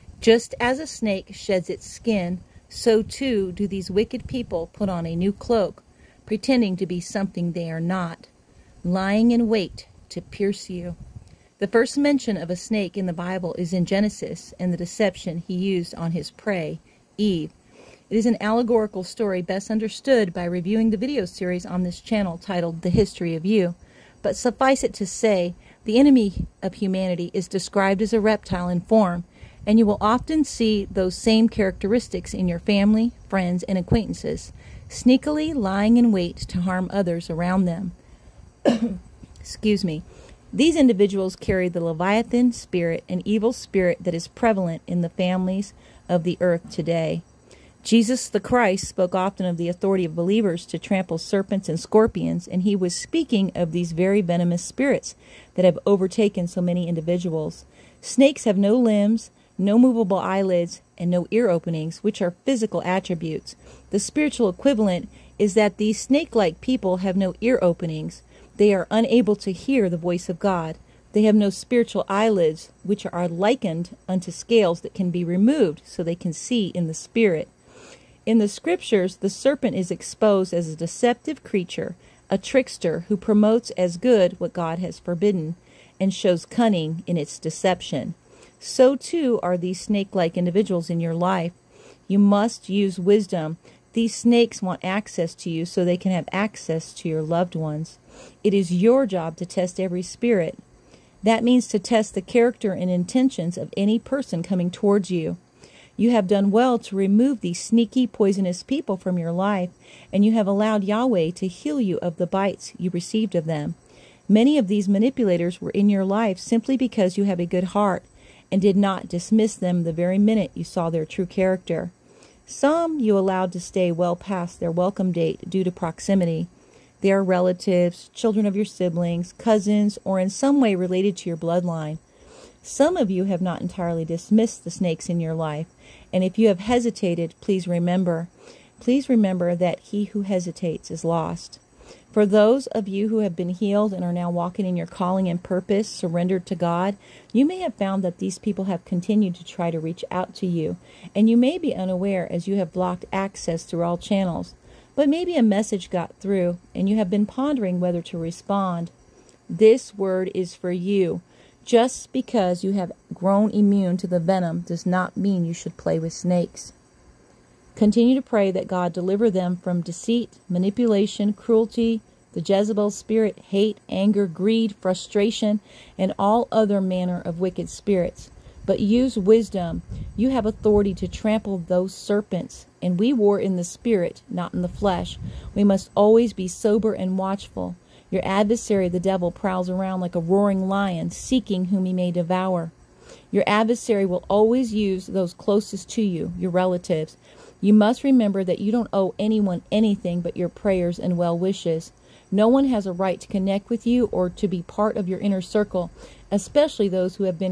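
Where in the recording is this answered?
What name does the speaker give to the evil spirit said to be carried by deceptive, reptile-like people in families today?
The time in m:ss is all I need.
0:41.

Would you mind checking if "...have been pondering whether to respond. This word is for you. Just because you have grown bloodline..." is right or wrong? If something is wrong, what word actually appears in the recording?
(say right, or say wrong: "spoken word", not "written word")
wrong: "immune", not "bloodline".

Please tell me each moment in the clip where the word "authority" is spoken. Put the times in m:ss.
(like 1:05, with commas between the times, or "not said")
0:49, 3:00.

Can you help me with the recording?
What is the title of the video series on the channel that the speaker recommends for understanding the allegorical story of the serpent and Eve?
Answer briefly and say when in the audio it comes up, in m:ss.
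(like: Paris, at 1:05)
The History of You, at 0:22.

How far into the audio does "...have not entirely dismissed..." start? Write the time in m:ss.
2:13.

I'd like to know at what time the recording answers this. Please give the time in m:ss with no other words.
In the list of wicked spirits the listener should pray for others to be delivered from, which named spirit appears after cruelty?
2:52.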